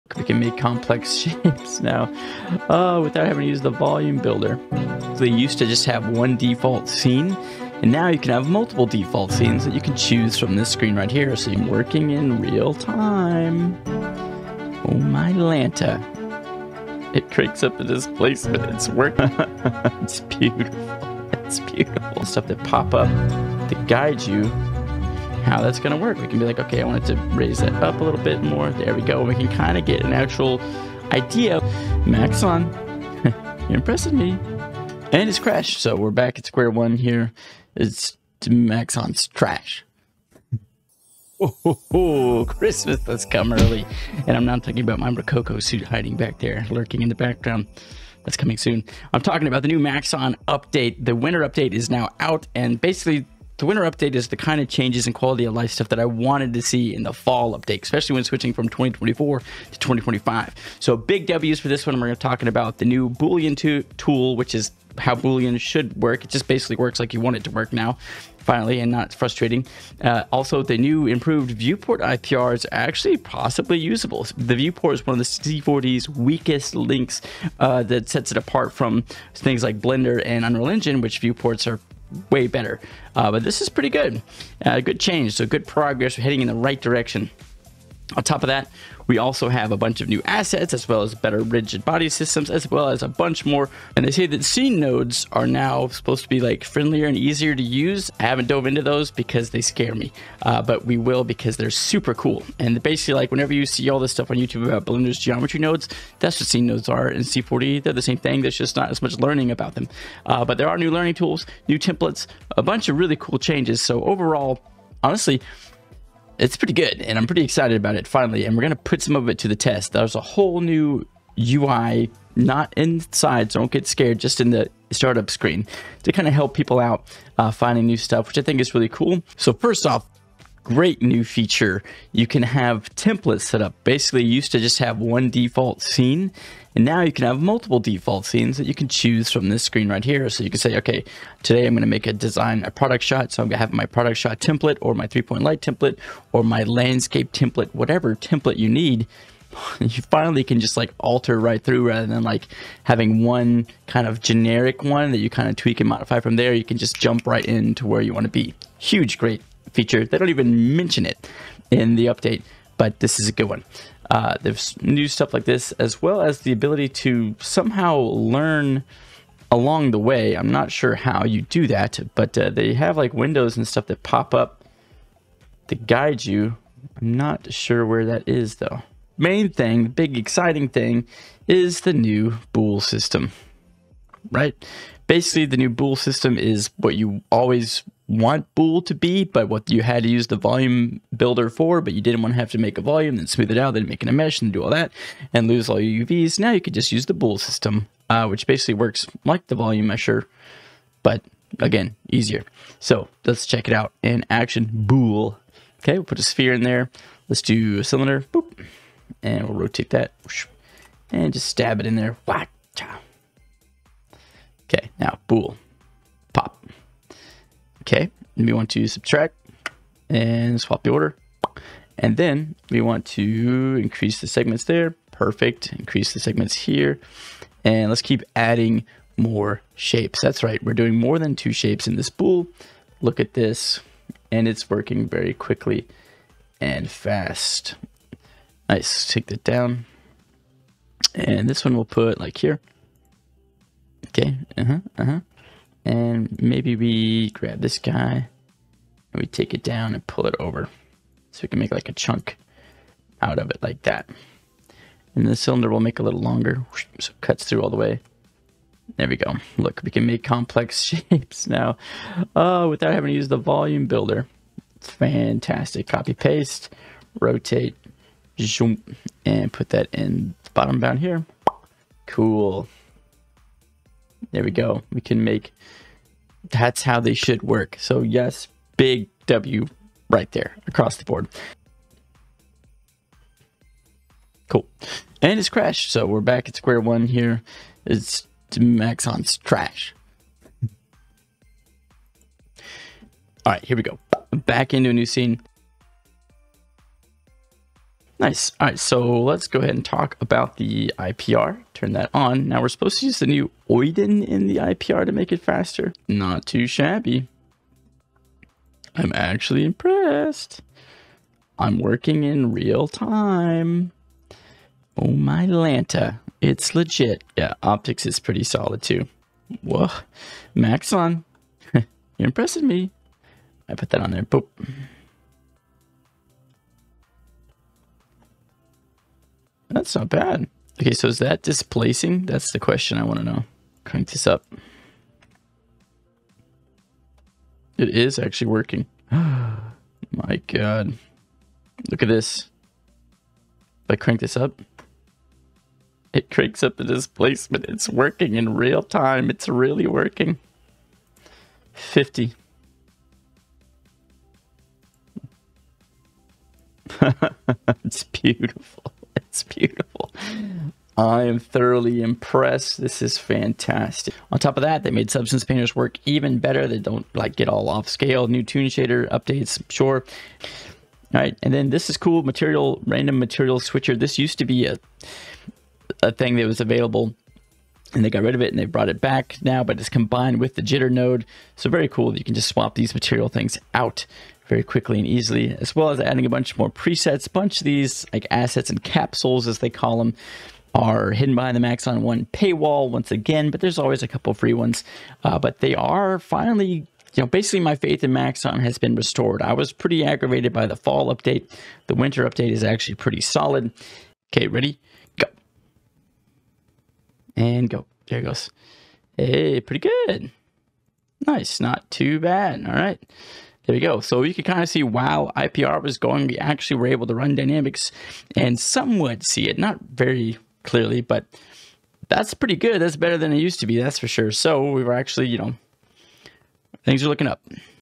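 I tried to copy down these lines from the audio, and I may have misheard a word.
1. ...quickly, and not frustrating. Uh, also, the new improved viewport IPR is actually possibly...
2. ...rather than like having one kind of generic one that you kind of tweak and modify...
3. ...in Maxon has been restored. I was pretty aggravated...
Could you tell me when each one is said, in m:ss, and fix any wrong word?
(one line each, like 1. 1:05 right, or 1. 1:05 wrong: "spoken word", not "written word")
1. 1:08 wrong: "finally", not "quickly"
2. 2:31 right
3. 6:38 right.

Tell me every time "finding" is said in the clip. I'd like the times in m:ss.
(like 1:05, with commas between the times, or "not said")
2:07.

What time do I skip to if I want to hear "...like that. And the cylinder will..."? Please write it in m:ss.
4:13.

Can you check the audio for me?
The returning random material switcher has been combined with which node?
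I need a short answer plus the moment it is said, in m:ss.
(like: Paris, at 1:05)
jitter node, at 6:20.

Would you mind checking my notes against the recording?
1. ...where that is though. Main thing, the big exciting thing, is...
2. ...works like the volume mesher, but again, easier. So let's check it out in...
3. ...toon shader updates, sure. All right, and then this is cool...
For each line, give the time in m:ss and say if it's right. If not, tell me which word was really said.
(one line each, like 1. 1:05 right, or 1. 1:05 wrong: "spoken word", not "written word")
1. 2:57 right
2. 3:18 right
3. 6:08 right.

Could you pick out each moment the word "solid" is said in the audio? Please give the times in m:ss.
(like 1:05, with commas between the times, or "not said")
5:18, 6:43.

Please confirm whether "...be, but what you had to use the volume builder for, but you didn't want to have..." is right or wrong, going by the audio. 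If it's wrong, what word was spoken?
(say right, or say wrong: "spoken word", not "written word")
right.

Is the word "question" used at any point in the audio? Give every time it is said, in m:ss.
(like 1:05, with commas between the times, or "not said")
5:32.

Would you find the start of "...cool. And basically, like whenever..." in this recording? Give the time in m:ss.
1:42.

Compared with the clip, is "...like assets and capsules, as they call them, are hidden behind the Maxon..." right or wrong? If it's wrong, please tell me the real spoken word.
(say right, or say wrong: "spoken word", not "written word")
right.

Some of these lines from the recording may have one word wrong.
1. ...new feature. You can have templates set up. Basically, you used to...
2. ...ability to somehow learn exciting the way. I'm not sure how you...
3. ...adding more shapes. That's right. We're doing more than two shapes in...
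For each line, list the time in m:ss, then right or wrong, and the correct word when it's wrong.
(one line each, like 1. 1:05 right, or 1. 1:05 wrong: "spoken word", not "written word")
1. 2:11 right
2. 2:46 wrong: "along", not "exciting"
3. 3:48 right.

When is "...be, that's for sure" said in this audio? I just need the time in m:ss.
7:03.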